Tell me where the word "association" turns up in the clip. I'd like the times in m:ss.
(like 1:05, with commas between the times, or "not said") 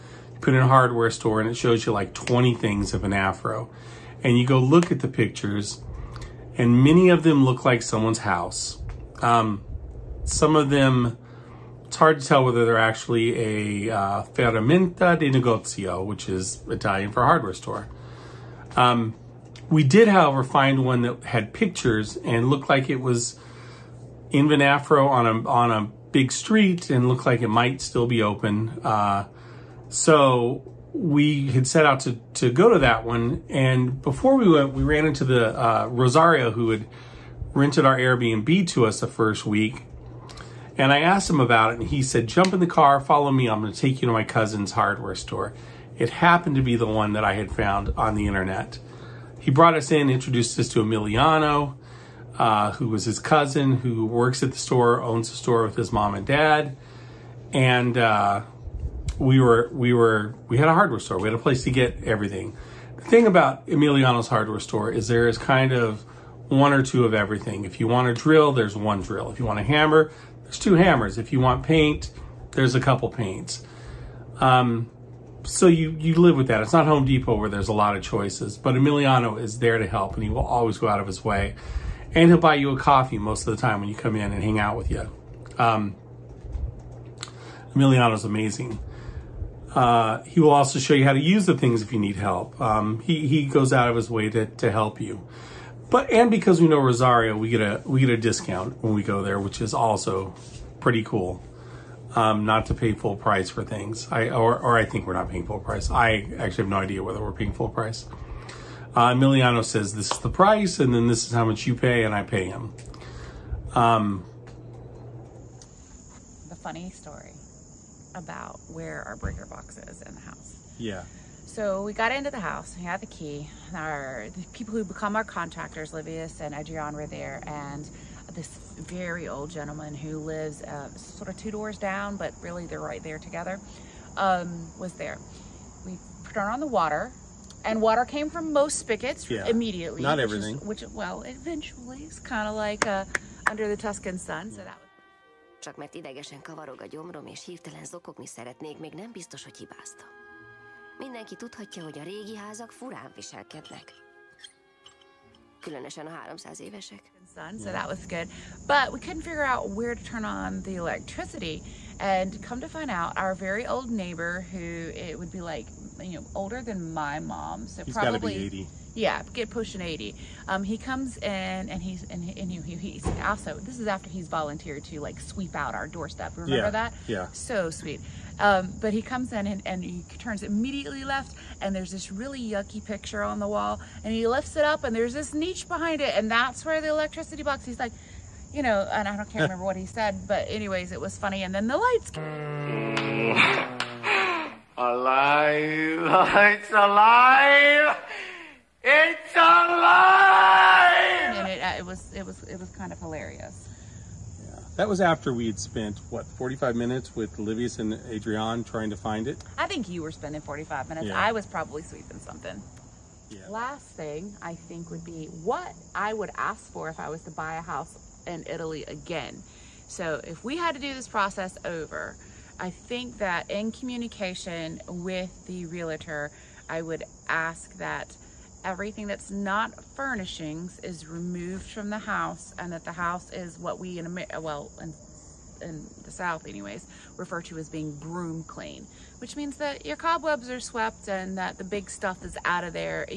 not said.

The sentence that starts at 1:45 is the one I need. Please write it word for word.
I actually have no idea whether we're paying full price.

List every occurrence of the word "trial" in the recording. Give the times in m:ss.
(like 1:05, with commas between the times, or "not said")
not said.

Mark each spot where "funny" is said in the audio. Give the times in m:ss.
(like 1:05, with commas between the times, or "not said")
1:56, 3:11.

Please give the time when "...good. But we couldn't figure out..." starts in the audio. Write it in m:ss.
2:38.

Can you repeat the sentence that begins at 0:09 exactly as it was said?
Um, some of them, it's hard to tell whether they're actually a uh, ferramenta di negozio, which is Italian for hardware store.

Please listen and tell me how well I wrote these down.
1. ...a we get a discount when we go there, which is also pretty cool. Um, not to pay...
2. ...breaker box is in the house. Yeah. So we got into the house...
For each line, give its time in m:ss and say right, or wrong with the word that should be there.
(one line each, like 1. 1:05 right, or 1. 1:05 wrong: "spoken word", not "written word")
1. 1:37 right
2. 1:59 right.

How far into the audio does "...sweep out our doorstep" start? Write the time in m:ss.
2:55.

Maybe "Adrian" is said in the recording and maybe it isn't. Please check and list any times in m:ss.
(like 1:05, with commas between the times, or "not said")
2:06, 3:28.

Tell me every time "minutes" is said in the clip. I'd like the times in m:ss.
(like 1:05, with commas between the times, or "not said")
3:26, 3:30.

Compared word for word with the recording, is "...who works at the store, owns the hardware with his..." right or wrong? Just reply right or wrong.
wrong.